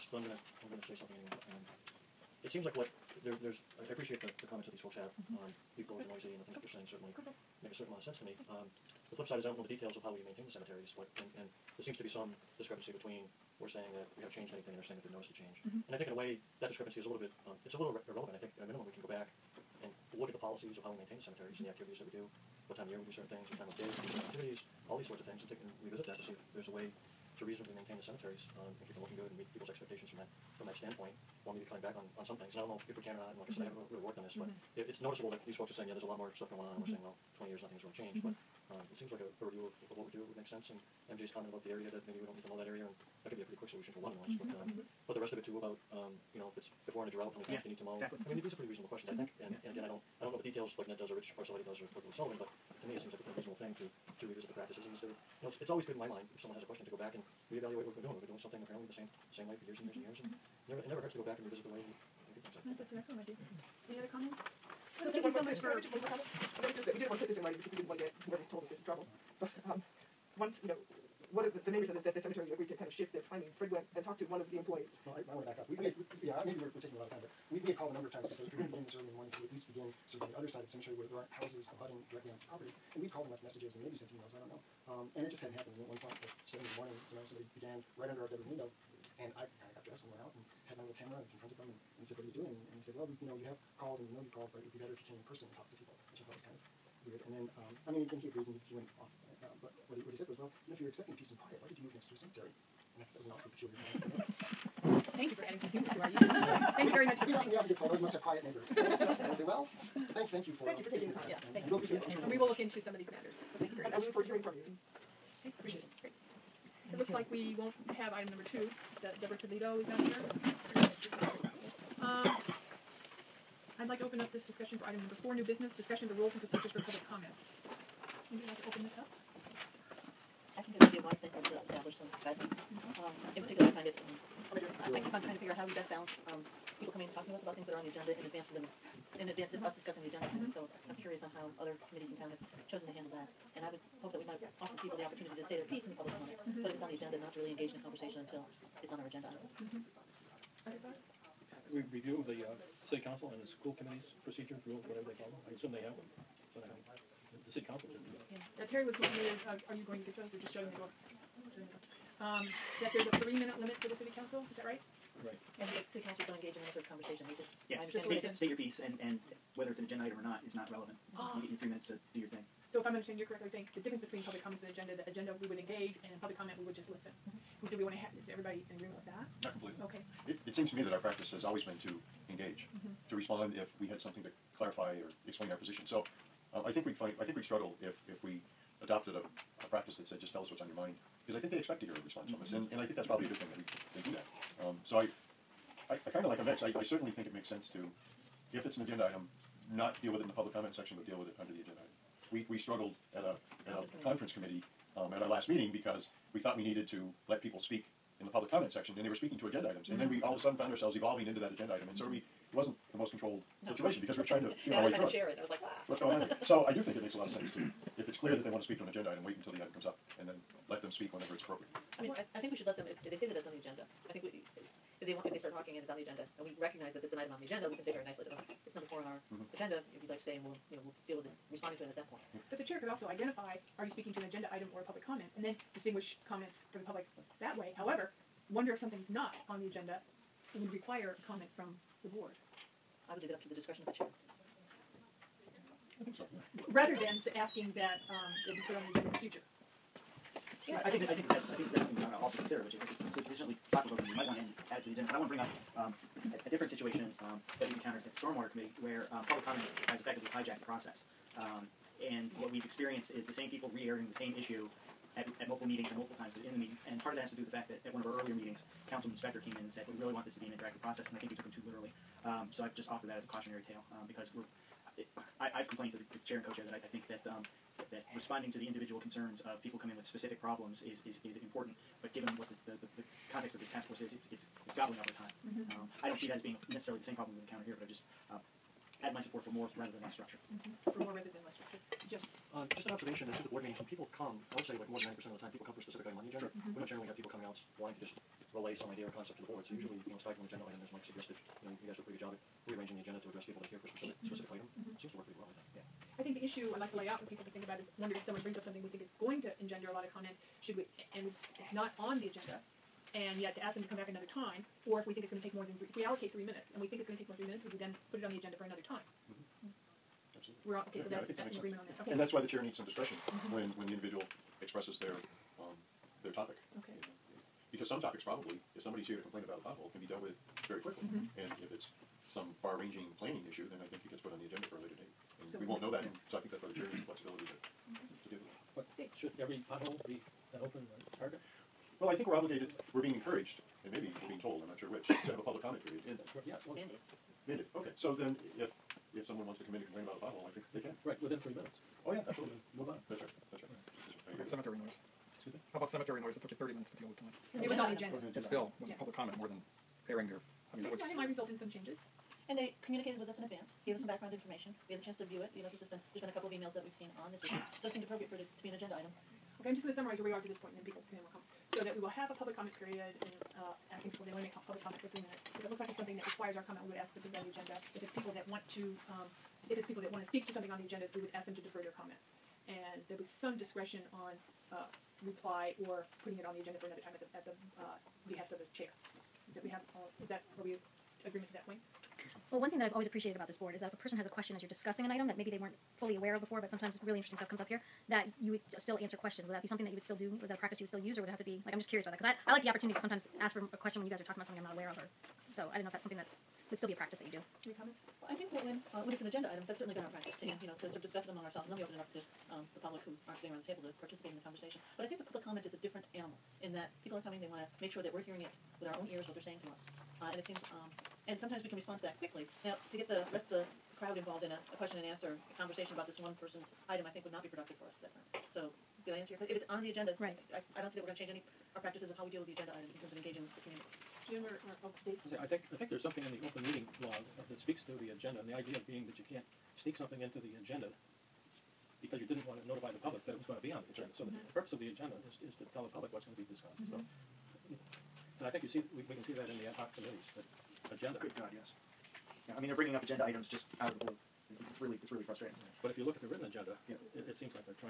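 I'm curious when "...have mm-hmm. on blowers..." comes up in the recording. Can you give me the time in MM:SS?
00:04.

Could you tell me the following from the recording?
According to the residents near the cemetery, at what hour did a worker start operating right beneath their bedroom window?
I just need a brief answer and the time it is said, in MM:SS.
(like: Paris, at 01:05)
7 in the morning, at 01:26.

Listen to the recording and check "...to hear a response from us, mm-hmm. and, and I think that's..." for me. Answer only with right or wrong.
right.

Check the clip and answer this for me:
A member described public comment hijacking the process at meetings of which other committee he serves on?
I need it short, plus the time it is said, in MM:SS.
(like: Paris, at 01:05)
Stormwater Committee, at 04:18.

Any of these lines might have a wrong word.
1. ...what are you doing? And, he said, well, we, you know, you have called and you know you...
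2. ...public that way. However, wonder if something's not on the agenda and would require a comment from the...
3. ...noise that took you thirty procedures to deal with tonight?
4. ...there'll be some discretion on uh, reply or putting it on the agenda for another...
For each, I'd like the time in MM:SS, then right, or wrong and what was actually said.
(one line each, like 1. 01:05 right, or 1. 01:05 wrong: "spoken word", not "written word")
1. 01:32 right
2. 03:56 right
3. 05:56 wrong: "minutes", not "procedures"
4. 06:23 right.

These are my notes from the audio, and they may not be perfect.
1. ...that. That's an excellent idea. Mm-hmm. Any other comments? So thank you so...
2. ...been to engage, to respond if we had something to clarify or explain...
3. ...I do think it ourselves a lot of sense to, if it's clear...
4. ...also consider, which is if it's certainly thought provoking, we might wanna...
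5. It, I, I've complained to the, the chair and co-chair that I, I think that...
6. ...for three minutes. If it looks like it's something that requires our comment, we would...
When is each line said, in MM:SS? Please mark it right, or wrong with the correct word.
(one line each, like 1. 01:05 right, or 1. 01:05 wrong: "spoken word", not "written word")
1. 01:02 right
2. 03:01 right
3. 03:36 wrong: "makes", not "ourselves"
4. 04:12 wrong: "sufficiently", not "certainly"
5. 04:34 right
6. 06:15 right.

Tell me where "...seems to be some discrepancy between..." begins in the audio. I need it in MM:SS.
00:11.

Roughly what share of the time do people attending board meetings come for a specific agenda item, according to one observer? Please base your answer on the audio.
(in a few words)
more than 90%.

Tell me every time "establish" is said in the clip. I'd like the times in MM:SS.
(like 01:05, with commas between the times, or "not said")
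02:11.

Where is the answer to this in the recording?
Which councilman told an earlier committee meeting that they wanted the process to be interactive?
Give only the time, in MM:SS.
04:28.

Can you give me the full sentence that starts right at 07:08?
So did I answer your question?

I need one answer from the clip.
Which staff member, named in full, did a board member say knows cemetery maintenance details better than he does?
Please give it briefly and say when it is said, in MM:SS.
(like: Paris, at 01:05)
Rich Parasiliti, at 00:51.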